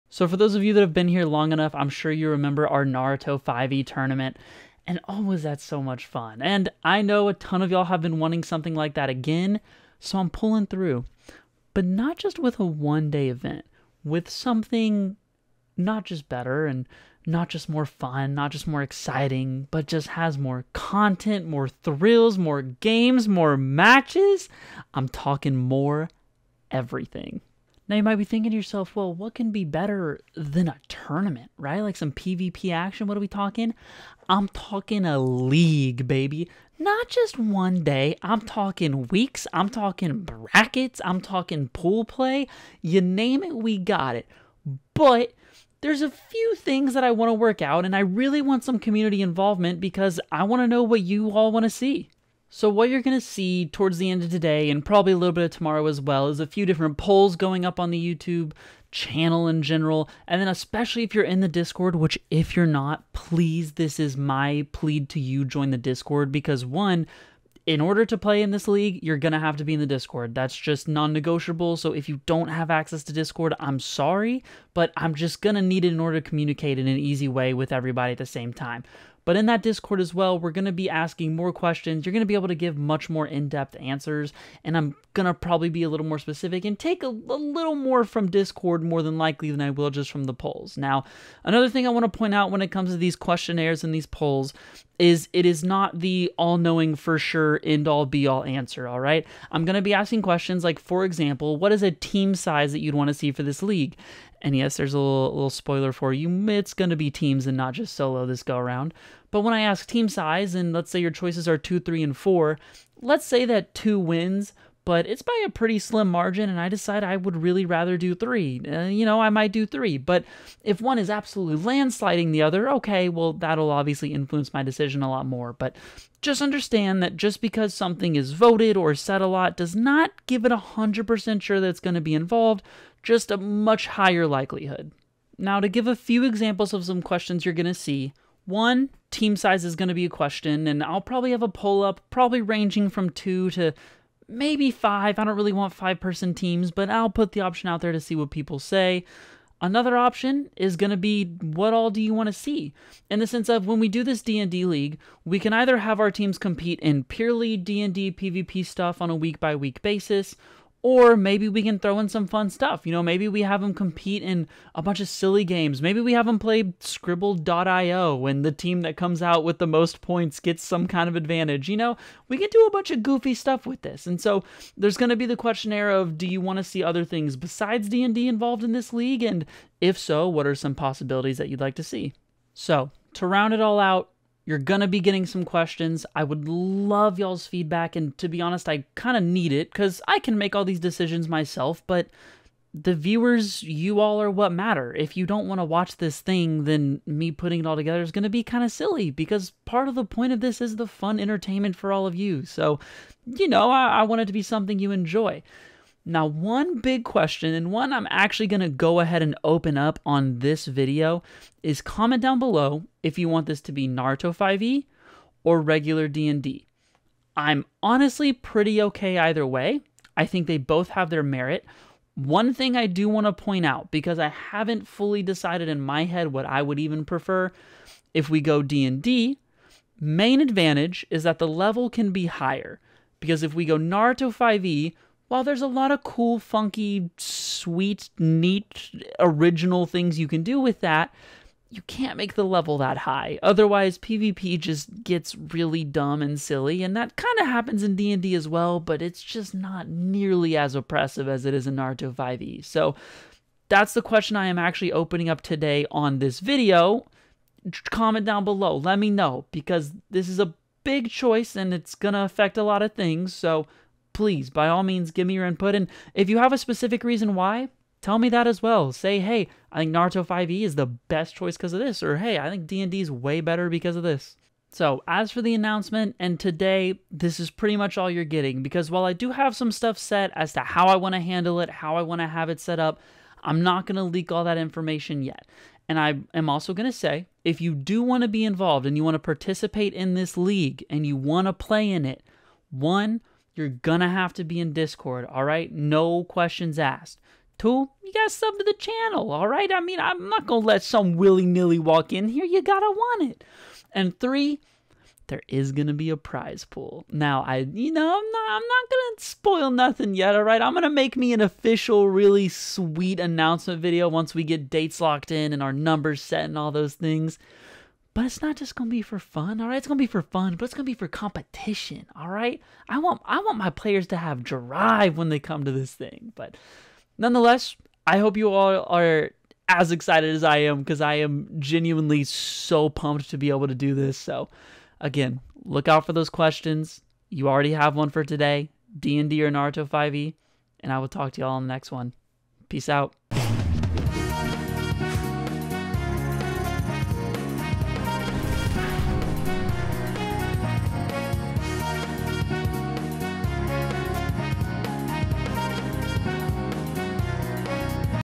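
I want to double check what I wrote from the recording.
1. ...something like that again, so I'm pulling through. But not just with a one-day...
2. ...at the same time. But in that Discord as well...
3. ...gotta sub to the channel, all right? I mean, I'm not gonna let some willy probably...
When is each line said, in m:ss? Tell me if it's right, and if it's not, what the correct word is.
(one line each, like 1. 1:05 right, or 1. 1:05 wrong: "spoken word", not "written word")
1. 0:08 right
2. 1:18 right
3. 4:58 wrong: "nilly", not "probably".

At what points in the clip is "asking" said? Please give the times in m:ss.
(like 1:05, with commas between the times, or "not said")
1:20, 1:39.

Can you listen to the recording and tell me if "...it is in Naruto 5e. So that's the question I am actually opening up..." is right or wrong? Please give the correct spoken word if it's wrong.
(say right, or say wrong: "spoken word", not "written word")
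right.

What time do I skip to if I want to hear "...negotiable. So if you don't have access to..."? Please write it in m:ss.
1:11.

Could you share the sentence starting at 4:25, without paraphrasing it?
And if you have a specific reason why, tell me that as well.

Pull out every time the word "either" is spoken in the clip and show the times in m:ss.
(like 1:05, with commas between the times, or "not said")
2:35, 3:39.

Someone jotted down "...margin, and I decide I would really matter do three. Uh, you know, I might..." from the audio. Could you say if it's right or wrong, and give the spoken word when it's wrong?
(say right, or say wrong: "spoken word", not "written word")
wrong: "rather", not "matter".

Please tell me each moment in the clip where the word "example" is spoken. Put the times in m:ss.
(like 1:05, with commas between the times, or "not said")
1:41, 2:16.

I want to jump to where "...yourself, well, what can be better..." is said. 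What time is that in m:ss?
0:28.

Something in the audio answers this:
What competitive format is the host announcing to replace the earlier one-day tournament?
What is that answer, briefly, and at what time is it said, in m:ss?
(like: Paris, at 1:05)
A league, at 0:35.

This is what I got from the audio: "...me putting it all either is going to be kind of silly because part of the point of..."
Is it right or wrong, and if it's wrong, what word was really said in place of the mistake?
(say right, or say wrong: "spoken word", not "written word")
wrong: "together", not "either".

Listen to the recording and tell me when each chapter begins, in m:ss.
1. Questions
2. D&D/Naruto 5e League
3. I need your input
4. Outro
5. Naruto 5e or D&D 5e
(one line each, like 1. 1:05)
1. 2:15
2. 0:27
3. 0:52
4. 4:34
5. 3:02.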